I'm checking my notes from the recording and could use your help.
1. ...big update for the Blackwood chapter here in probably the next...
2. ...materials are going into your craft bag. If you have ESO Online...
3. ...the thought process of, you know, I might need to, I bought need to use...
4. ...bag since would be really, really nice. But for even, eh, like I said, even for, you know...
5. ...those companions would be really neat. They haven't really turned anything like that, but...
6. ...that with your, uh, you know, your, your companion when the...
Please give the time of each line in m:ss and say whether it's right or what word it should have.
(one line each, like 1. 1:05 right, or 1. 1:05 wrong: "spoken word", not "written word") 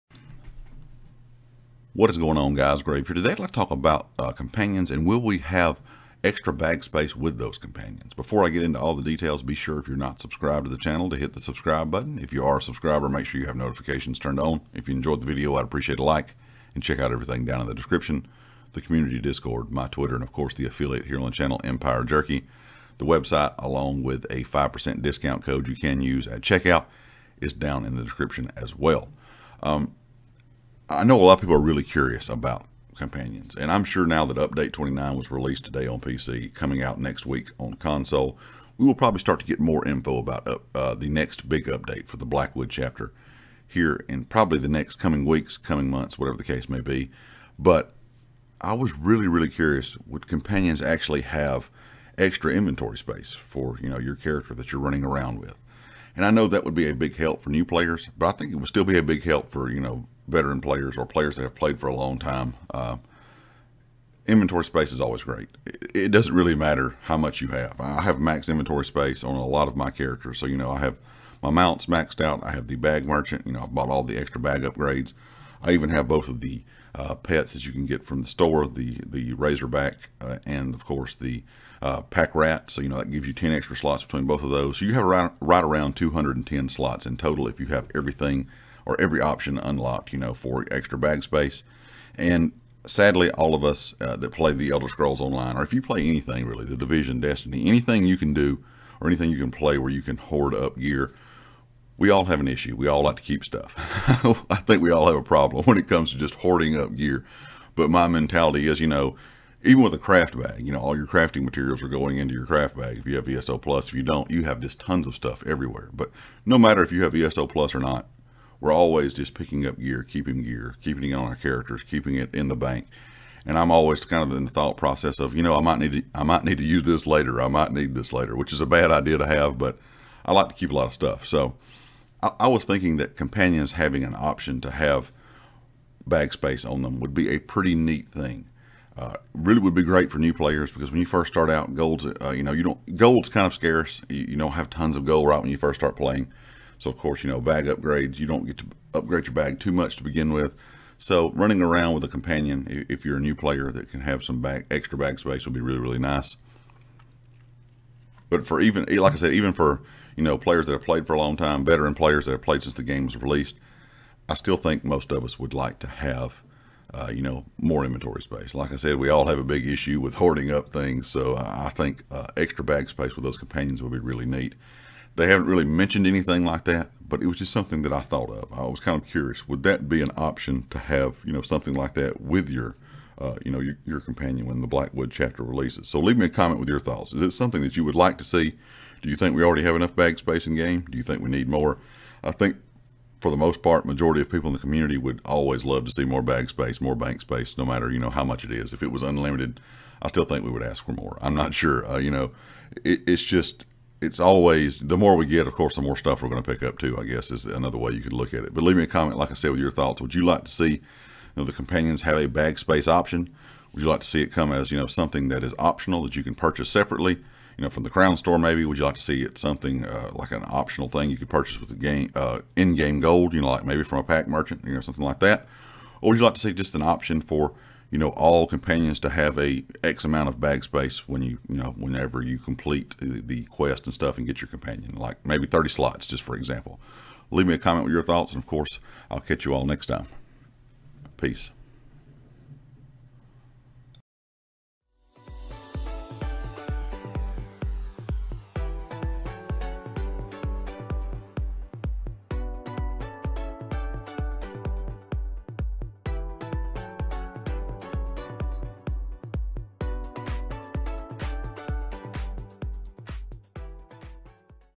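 1. 0:41 right
2. 1:51 wrong: "Plus", not "Online"
3. 2:04 wrong: "might", not "bought"
4. 2:34 wrong: "space", not "since"
5. 2:53 wrong: "mentioned", not "turned"
6. 3:01 right.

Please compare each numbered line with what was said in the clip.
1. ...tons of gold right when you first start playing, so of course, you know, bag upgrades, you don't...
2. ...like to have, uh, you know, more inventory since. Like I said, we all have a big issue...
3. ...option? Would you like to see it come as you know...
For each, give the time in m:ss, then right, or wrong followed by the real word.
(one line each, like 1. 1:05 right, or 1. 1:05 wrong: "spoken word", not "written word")
1. 2:24 right
2. 2:45 wrong: "space", not "since"
3. 3:32 right.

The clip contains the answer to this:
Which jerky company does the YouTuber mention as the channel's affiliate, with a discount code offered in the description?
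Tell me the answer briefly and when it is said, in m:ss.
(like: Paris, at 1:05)
Empire Jerky, at 0:21.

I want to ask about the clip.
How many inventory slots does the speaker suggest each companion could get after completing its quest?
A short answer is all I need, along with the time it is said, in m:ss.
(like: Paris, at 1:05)
30, at 3:55.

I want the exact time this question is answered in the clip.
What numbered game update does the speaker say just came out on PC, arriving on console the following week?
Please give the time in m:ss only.
0:34.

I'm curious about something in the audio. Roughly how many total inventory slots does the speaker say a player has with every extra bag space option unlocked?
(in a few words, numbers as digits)
210.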